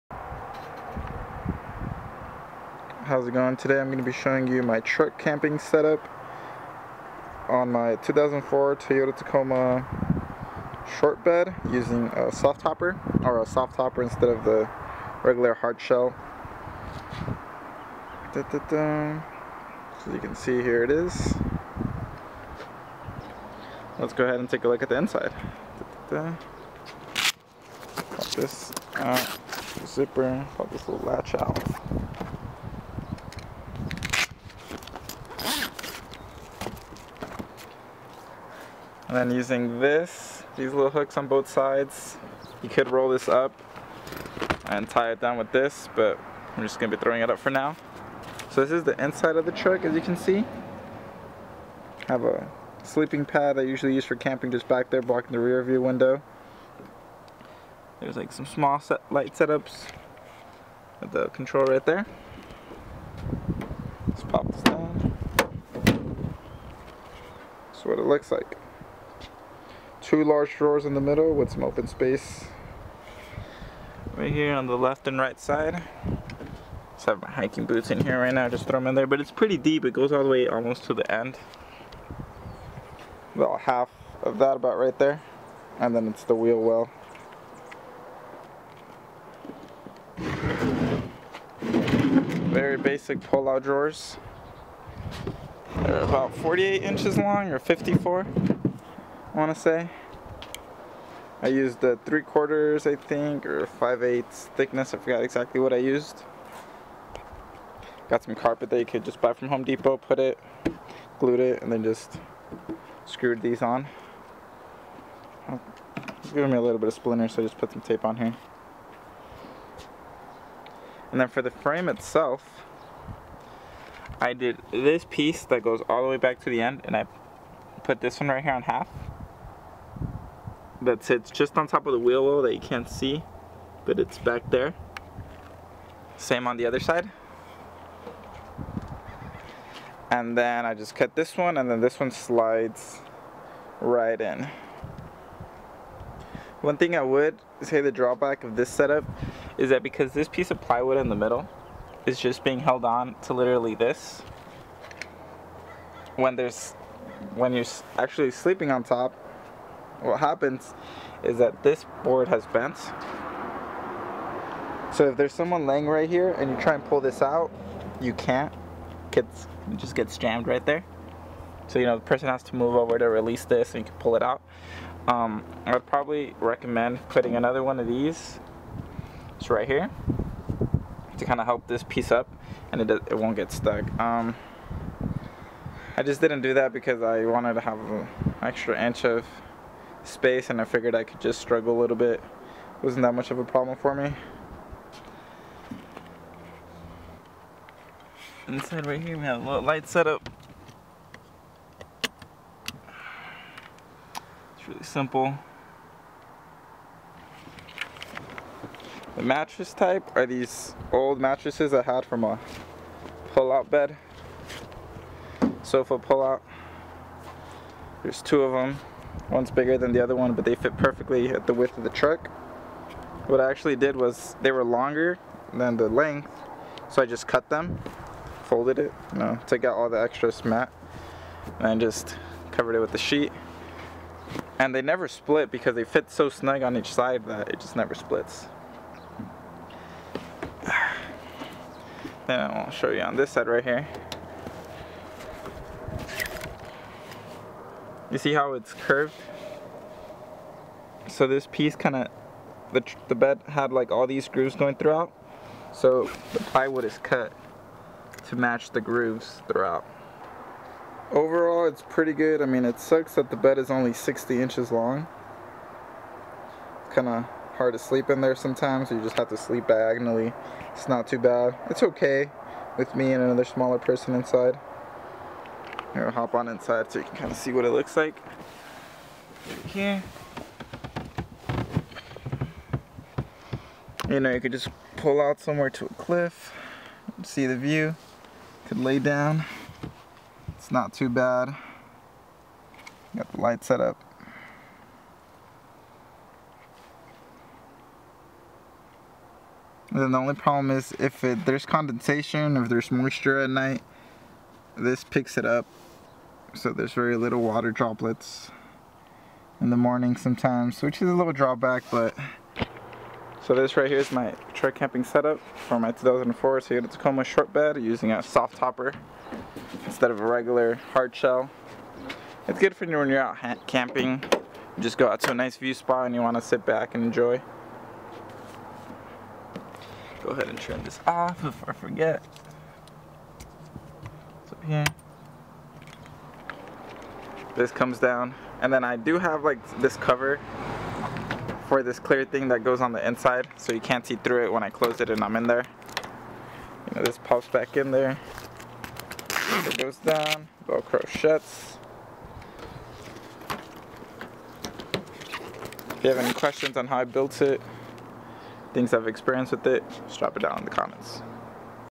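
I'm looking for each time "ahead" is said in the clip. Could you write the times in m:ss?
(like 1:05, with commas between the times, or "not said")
0:24, 5:30.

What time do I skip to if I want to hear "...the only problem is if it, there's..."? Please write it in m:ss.
5:00.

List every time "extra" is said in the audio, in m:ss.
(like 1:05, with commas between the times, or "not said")
3:08, 3:50.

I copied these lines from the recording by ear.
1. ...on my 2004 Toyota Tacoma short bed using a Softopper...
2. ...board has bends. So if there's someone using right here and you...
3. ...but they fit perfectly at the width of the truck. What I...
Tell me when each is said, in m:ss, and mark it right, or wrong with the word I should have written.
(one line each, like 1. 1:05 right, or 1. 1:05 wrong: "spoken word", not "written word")
1. 0:07 right
2. 2:42 wrong: "laying", not "using"
3. 3:40 right.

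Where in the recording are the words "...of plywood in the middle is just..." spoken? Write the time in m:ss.
2:30.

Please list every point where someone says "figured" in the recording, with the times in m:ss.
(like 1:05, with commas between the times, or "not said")
3:10.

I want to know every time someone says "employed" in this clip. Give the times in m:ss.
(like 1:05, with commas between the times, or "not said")
not said.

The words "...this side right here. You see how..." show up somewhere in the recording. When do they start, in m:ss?
4:03.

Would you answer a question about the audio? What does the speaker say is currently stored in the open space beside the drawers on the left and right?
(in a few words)
hiking boots.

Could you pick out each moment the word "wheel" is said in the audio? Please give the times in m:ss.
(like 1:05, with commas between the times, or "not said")
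1:26, 2:11.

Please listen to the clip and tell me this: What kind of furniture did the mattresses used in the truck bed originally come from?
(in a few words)
Sofa pull-out.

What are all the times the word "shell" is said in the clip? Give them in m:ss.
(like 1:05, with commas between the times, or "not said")
0:15, 5:21.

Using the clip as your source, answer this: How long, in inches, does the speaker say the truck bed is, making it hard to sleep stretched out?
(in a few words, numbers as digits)
60 inches.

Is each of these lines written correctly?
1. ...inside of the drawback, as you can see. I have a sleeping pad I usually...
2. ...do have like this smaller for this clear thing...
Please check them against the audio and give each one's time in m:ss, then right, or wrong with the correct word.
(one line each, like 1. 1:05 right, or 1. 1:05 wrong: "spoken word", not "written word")
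1. 0:49 wrong: "truck", not "drawback"
2. 5:38 wrong: "cover", not "smaller".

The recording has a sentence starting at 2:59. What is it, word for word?
It's right here to kind of help this piece up and it, it won't get stuck.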